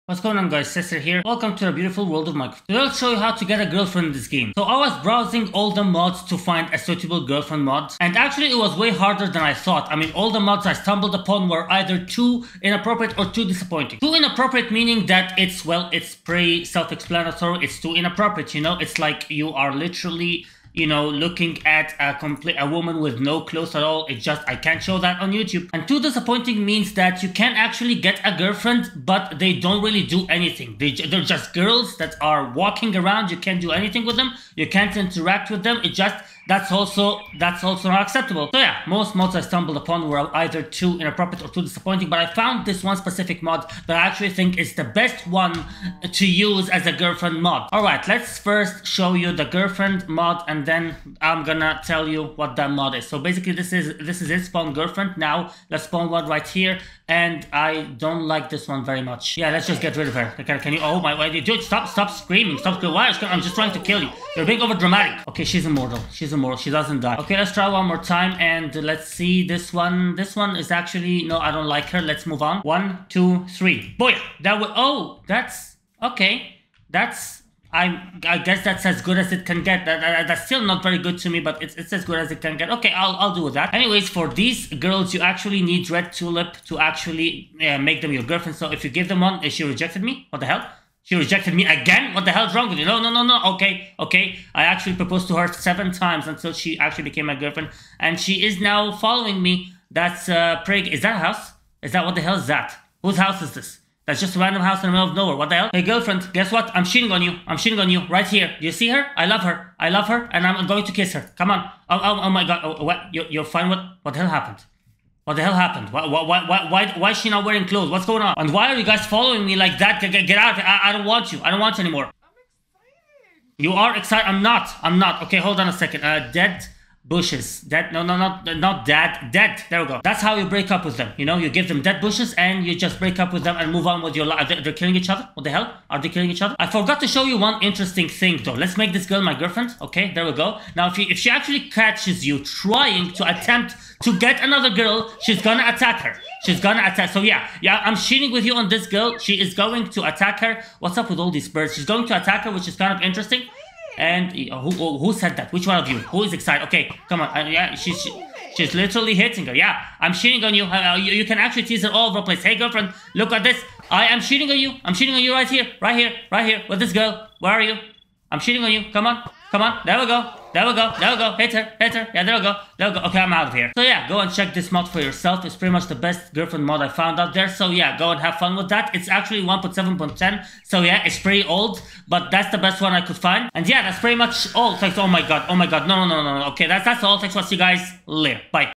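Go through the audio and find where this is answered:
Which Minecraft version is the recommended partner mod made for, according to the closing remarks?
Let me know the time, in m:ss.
2:59.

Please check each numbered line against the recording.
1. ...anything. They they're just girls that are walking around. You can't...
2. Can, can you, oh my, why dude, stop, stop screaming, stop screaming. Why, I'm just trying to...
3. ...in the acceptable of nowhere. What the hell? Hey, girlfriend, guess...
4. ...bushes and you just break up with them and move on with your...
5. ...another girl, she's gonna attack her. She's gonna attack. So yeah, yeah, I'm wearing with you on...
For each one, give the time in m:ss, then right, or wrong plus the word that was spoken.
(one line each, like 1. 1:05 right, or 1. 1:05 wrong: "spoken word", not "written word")
1. 0:30 right
2. 1:00 right
3. 1:44 wrong: "middle", not "acceptable"
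4. 2:12 right
5. 2:24 wrong: "cheating", not "wearing".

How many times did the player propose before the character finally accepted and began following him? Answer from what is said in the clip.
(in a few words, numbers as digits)
7.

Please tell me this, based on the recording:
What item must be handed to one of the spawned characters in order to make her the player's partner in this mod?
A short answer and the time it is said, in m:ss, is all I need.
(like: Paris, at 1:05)
Red tulip, at 1:25.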